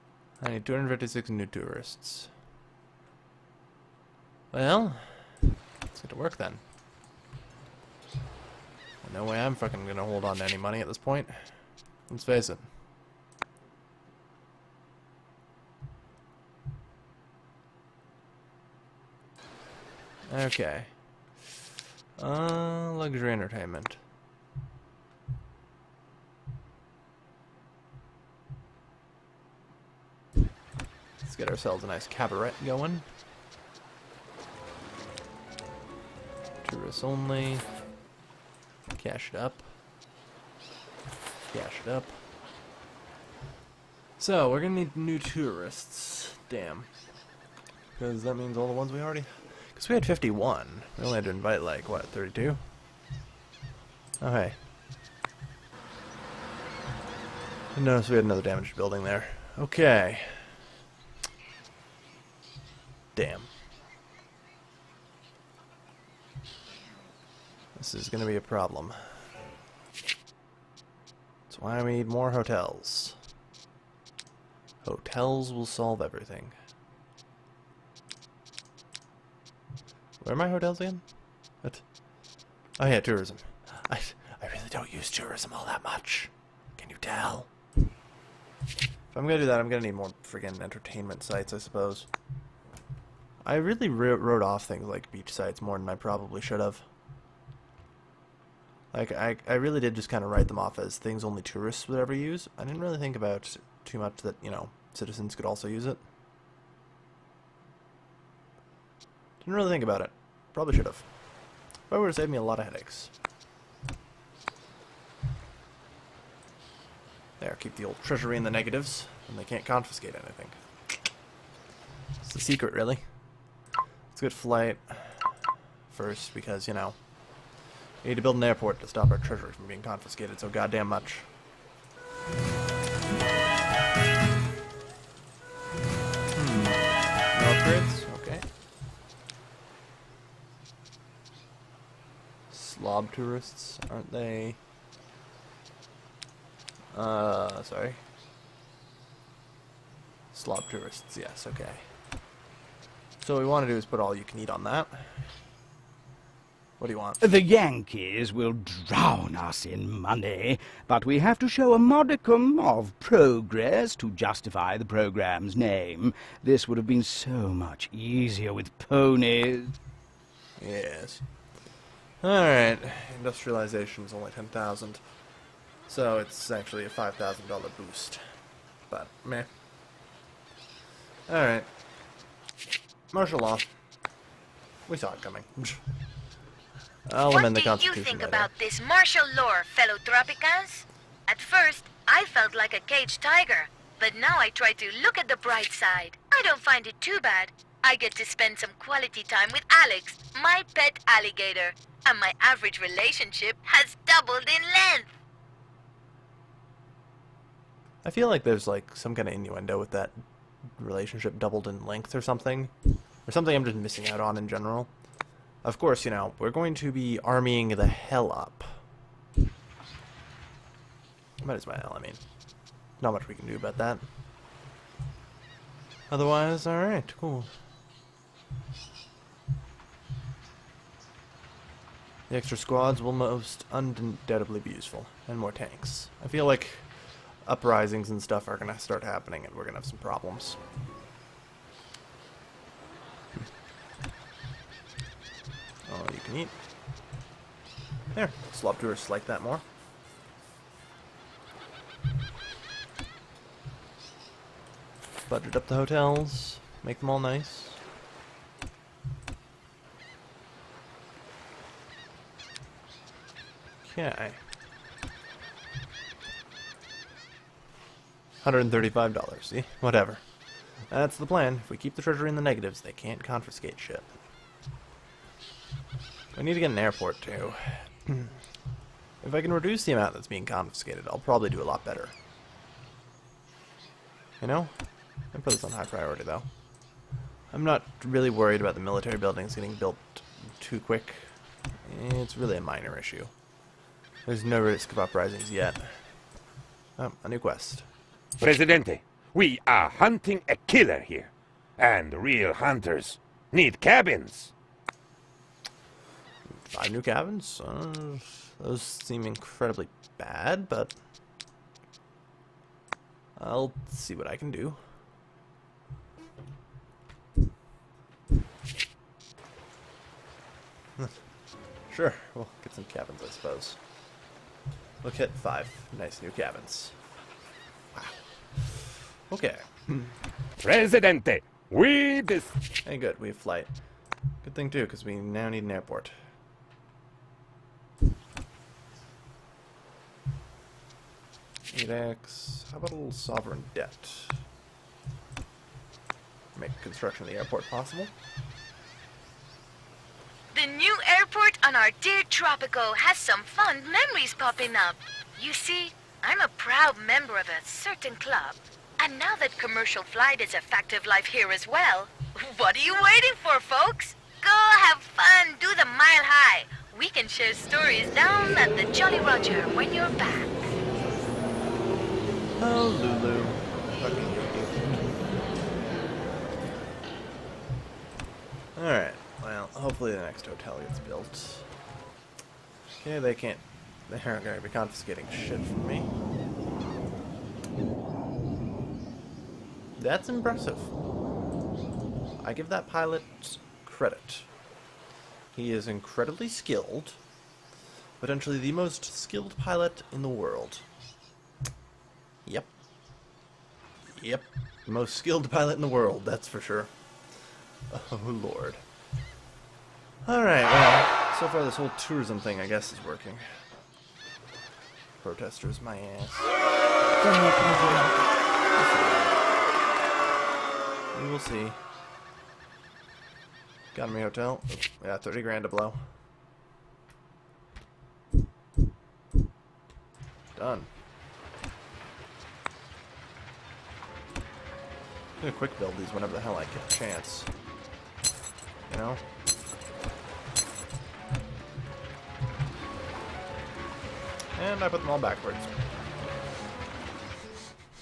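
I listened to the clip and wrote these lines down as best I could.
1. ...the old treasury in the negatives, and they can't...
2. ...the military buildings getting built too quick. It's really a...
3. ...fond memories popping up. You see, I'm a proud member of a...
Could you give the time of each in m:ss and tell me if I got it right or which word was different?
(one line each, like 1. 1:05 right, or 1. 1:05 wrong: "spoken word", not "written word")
1. 1:57 right
2. 4:48 right
3. 5:53 right.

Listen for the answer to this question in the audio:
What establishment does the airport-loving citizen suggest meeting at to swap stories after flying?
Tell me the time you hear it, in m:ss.
6:08.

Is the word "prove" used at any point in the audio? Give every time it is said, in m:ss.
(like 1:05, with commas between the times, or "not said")
not said.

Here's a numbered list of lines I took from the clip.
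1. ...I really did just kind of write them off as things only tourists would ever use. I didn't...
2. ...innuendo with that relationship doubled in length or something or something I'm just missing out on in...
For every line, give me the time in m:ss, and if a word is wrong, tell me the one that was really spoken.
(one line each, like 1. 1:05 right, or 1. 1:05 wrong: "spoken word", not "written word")
1. 1:39 right
2. 3:29 right.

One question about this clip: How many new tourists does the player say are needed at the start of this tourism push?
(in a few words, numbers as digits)
256.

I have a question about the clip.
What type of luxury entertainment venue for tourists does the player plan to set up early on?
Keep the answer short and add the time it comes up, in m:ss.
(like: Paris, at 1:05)
cabaret, at 0:32.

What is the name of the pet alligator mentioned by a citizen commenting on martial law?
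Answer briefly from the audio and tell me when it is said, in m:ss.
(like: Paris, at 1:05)
Alex, at 3:19.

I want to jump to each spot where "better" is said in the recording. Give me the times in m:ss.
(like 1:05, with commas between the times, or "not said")
4:41.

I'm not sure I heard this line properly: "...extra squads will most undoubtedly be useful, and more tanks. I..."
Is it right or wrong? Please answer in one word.
right.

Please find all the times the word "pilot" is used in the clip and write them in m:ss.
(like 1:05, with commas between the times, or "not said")
6:32, 6:39, 6:45.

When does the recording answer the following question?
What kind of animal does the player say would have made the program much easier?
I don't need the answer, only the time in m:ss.
2:48.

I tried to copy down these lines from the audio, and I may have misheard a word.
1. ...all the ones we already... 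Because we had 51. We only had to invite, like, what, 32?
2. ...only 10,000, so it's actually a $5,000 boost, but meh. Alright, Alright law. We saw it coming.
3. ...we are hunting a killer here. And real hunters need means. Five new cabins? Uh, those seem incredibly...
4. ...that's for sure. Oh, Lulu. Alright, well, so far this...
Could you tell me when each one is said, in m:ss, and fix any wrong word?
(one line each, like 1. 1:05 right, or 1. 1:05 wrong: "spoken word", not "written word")
1. 0:48 right
2. 2:54 wrong: "Martial", not "Alright"
3. 4:59 wrong: "cabins", not "means"
4. 6:46 wrong: "Lord", not "Lulu".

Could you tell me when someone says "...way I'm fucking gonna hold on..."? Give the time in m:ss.
0:09.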